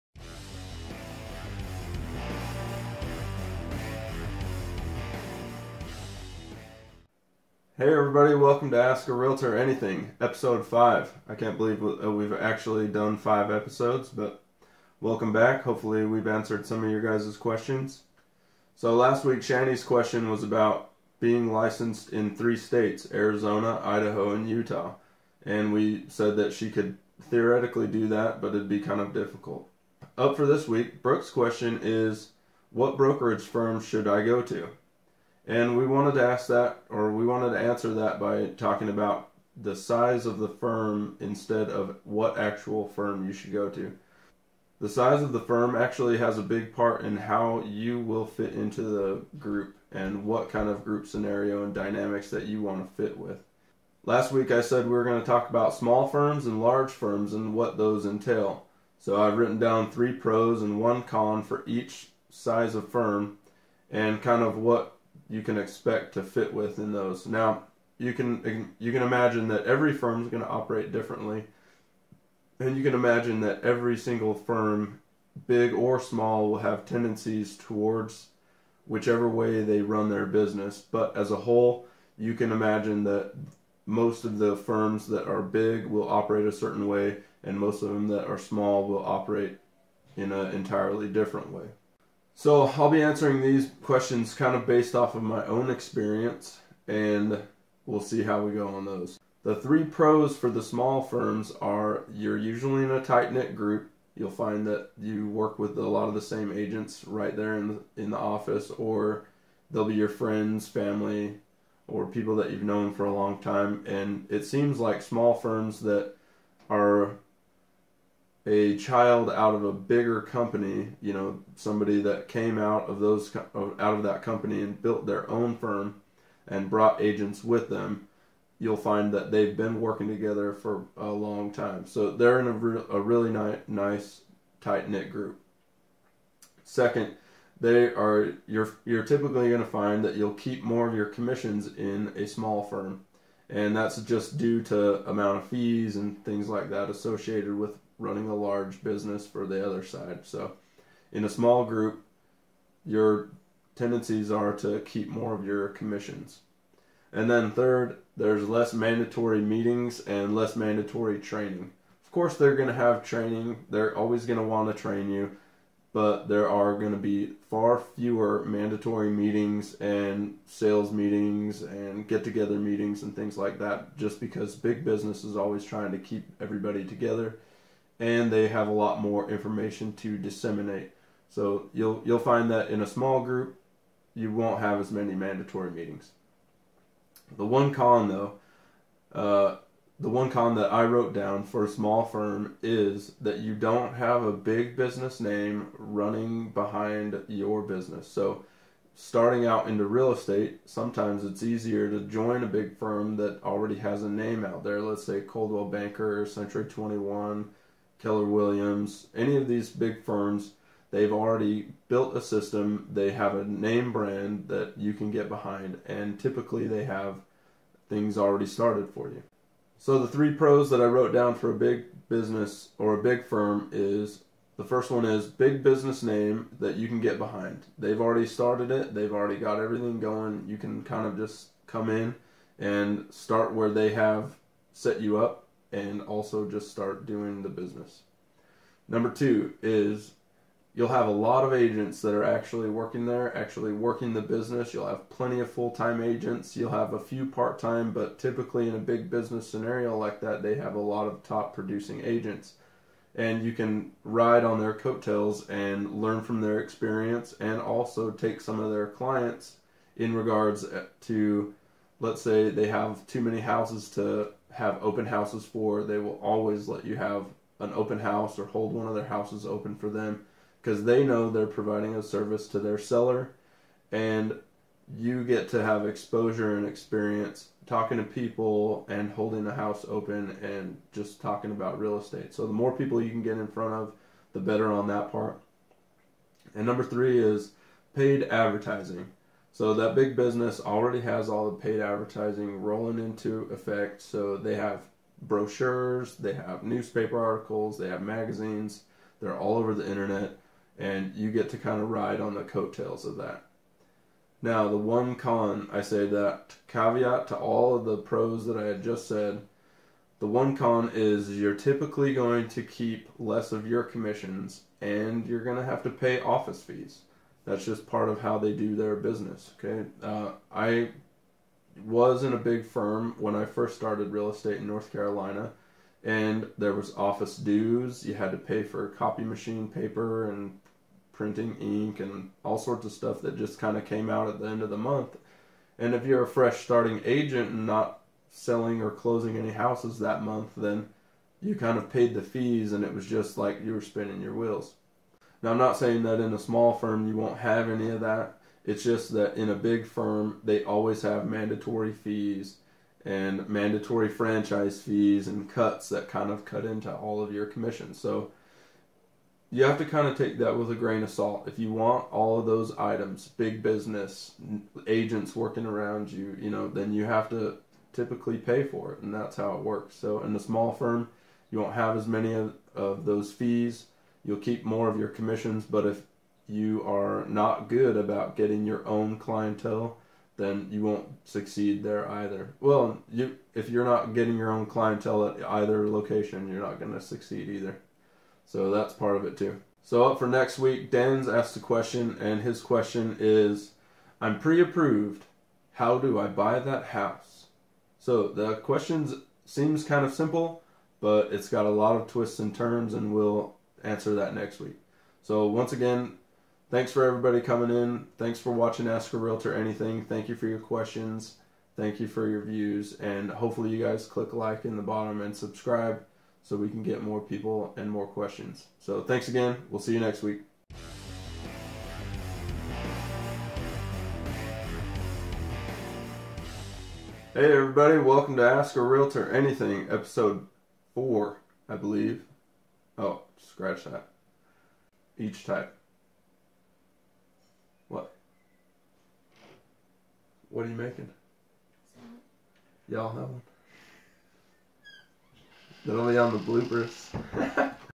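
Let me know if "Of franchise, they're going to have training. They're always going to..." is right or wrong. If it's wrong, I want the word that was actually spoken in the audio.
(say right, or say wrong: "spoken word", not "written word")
wrong: "course", not "franchise".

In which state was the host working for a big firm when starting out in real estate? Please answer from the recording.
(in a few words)
North Carolina.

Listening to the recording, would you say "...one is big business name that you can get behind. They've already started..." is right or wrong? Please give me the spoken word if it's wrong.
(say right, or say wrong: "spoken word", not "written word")
right.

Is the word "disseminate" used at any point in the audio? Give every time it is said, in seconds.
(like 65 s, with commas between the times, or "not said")
180 s.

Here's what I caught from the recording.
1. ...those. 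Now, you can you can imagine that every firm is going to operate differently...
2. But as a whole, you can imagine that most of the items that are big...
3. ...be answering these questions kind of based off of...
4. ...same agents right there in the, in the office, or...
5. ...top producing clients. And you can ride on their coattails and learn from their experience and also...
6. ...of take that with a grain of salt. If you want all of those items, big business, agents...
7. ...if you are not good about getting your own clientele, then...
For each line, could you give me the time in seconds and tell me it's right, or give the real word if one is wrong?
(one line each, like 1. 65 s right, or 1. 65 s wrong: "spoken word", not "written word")
1. 66 s right
2. 80 s wrong: "firms", not "items"
3. 92 s right
4. 106 s right
5. 251 s wrong: "agents", not "clients"
6. 360 s right
7. 375 s right.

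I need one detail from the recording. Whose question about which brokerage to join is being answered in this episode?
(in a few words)
Brooke.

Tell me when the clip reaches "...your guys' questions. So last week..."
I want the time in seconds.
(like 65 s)
16 s.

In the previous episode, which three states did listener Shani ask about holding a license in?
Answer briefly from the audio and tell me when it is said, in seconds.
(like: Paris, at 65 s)
Arizona, Idaho, and Utah, at 23 s.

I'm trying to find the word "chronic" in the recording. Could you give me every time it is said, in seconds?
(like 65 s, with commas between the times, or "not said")
not said.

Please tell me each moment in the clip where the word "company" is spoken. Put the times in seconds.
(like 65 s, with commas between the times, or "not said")
120 s, 124 s.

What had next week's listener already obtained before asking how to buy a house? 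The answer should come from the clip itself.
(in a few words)
Pre-approved.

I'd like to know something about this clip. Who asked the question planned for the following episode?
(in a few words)
Dan.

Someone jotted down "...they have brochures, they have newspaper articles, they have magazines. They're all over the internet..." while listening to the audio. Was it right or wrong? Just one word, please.
right.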